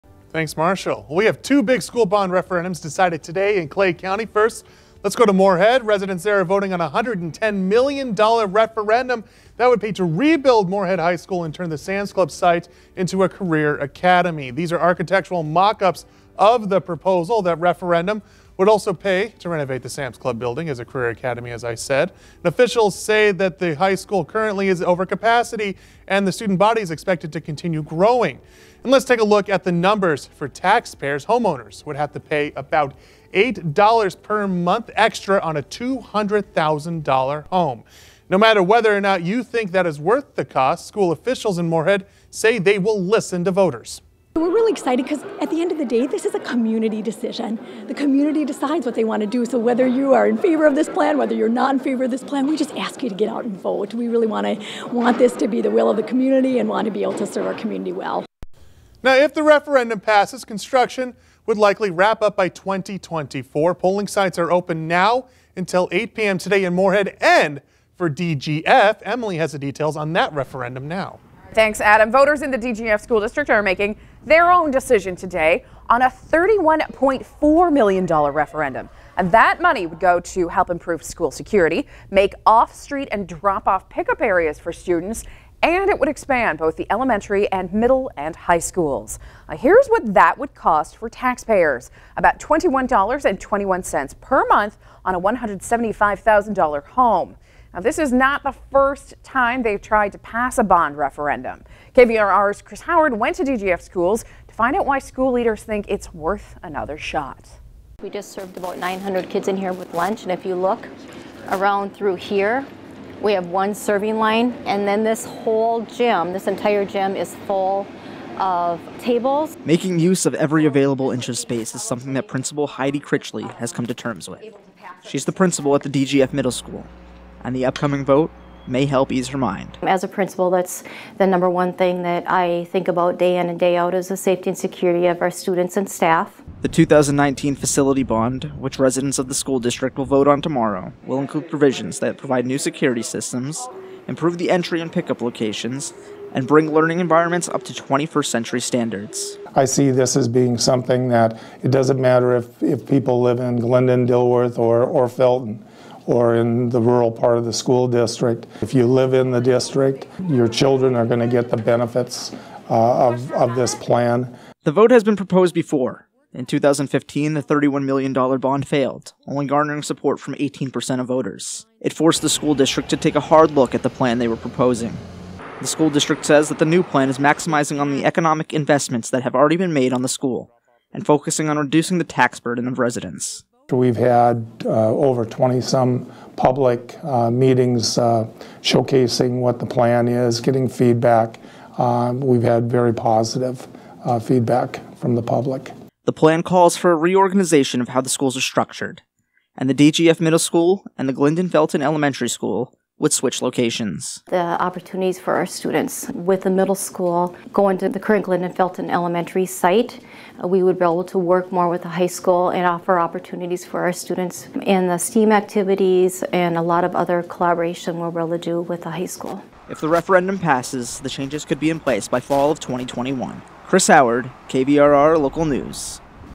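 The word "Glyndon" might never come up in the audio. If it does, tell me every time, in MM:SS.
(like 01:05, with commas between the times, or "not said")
02:33, 03:21.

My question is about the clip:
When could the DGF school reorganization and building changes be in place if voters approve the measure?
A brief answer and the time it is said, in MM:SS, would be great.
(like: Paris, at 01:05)
fall of 2021, at 03:42.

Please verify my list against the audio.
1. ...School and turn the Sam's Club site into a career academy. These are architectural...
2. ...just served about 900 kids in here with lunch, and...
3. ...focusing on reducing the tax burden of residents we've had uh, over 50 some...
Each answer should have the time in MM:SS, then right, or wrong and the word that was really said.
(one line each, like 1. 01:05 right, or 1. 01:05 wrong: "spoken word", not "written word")
1. 00:11 right
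2. 01:48 right
3. 03:01 wrong: "20", not "50".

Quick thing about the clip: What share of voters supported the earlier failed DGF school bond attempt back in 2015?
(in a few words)
18%.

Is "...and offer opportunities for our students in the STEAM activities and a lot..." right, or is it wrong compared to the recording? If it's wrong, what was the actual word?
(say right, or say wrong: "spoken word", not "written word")
right.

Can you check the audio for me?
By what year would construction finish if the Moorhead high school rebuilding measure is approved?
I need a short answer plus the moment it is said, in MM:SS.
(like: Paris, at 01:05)
2024, at 01:02.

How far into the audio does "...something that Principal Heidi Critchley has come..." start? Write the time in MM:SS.
02:01.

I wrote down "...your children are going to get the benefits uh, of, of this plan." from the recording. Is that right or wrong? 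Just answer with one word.
right.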